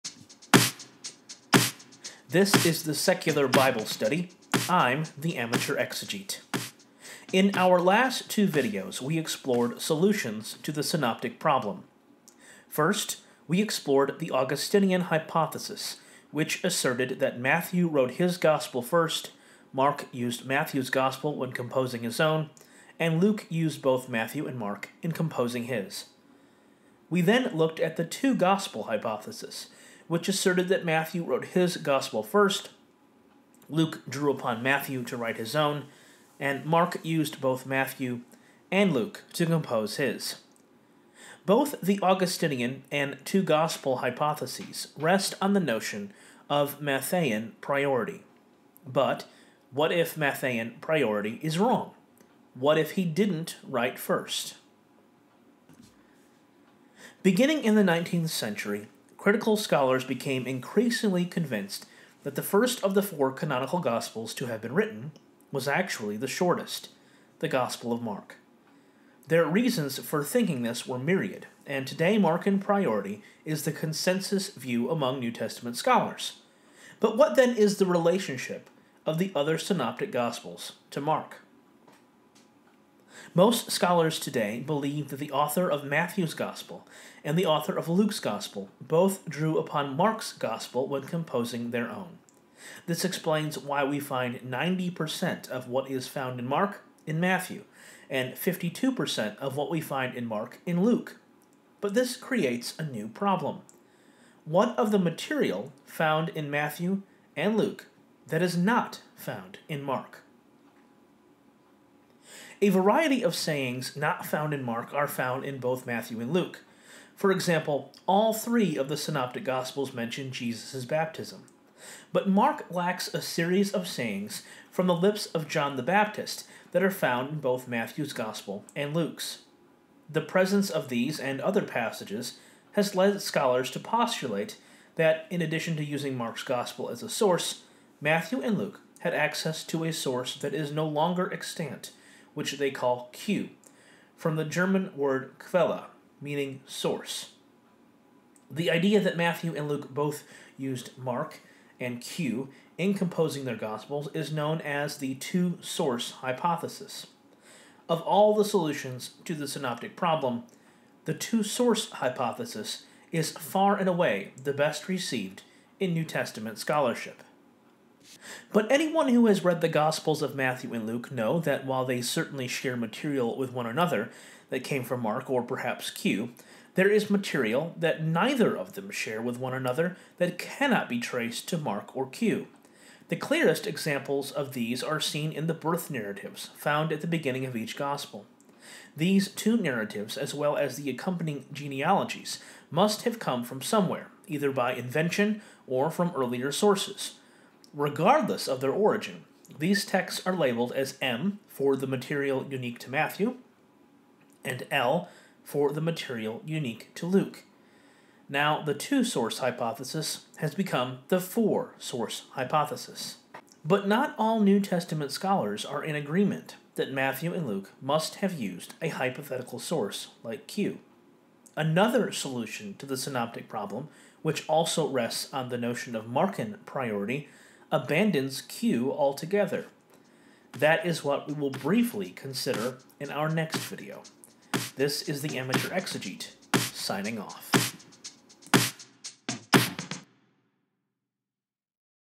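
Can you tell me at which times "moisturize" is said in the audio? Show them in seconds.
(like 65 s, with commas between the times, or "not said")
not said.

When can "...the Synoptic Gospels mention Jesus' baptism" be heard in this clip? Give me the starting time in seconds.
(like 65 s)
118 s.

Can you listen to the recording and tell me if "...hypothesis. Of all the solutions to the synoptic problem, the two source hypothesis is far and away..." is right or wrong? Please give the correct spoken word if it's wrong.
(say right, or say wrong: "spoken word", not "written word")
right.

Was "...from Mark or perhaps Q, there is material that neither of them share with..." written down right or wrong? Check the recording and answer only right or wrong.
right.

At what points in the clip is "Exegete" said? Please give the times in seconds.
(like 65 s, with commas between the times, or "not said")
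5 s, 235 s.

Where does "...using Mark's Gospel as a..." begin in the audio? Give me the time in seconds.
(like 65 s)
135 s.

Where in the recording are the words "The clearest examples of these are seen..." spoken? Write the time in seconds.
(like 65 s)
183 s.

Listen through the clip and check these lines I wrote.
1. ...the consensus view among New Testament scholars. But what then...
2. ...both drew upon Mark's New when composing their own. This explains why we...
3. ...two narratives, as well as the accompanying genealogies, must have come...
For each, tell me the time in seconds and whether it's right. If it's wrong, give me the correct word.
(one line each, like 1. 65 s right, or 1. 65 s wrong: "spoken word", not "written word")
1. 73 s right
2. 88 s wrong: "Gospel", not "New"
3. 189 s right.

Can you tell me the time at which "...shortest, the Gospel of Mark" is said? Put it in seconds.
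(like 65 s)
66 s.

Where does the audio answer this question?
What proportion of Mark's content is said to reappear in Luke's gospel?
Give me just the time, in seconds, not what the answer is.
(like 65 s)
98 s.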